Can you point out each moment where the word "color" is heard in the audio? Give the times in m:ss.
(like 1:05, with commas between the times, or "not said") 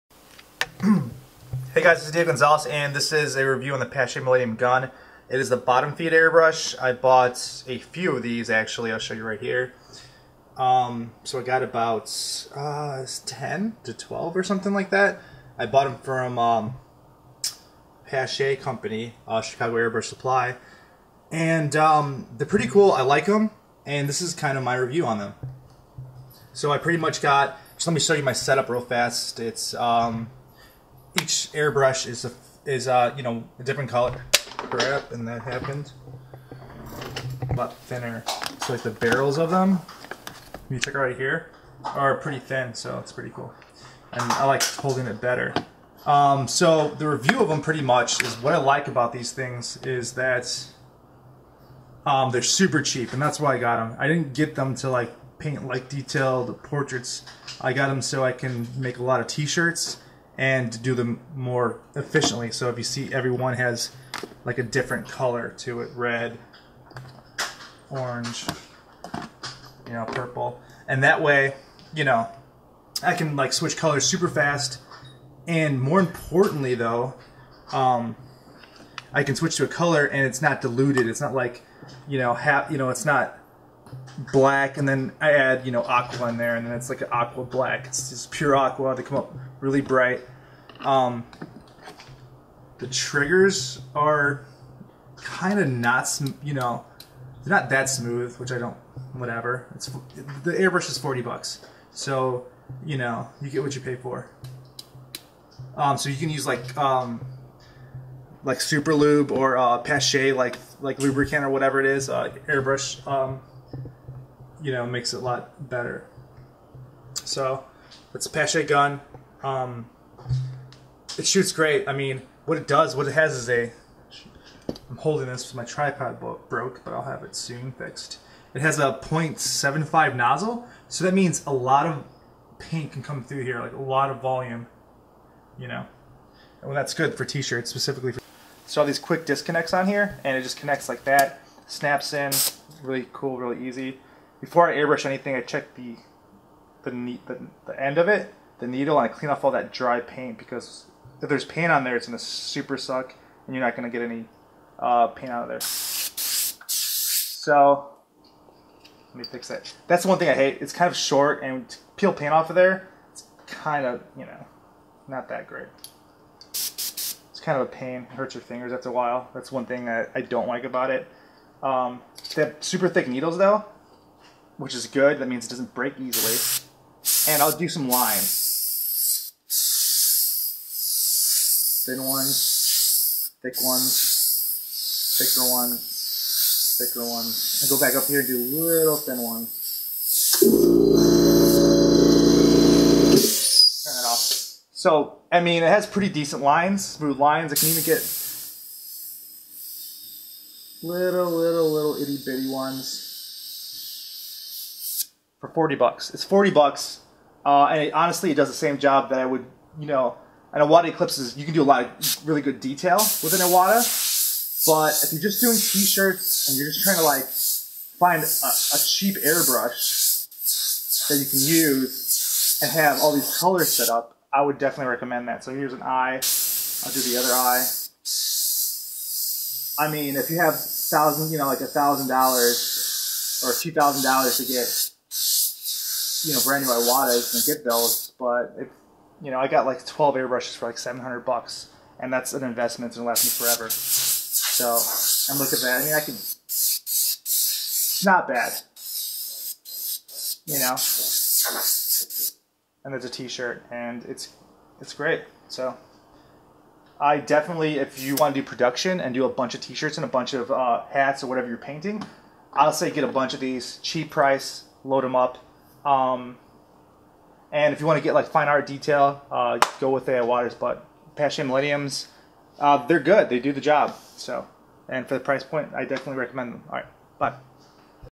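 0:33, 1:05, 1:13, 1:19, 3:43.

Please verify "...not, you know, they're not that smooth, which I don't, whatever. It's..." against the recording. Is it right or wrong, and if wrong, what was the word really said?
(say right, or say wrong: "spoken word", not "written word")
right.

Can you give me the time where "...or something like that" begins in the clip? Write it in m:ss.
0:14.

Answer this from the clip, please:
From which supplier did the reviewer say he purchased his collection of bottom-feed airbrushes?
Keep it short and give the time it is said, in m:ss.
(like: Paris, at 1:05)
Chicago Airbrush Supply, at 0:19.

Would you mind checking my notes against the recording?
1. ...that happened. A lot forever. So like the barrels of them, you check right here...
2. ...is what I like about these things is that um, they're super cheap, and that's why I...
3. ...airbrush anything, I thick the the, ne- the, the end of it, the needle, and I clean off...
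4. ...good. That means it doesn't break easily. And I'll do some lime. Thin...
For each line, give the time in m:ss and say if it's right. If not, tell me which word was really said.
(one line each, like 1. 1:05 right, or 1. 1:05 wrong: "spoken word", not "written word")
1. 0:35 wrong: "thinner", not "forever"
2. 0:48 right
3. 2:24 wrong: "check", not "thick"
4. 2:54 right.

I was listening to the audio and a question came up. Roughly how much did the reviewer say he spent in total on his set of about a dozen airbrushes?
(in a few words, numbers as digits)
$700.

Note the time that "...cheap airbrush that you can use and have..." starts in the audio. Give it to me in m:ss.
3:38.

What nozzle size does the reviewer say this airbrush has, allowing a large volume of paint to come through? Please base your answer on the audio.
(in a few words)
.75.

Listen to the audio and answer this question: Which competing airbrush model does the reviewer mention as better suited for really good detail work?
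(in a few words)
Iwata Eclipse.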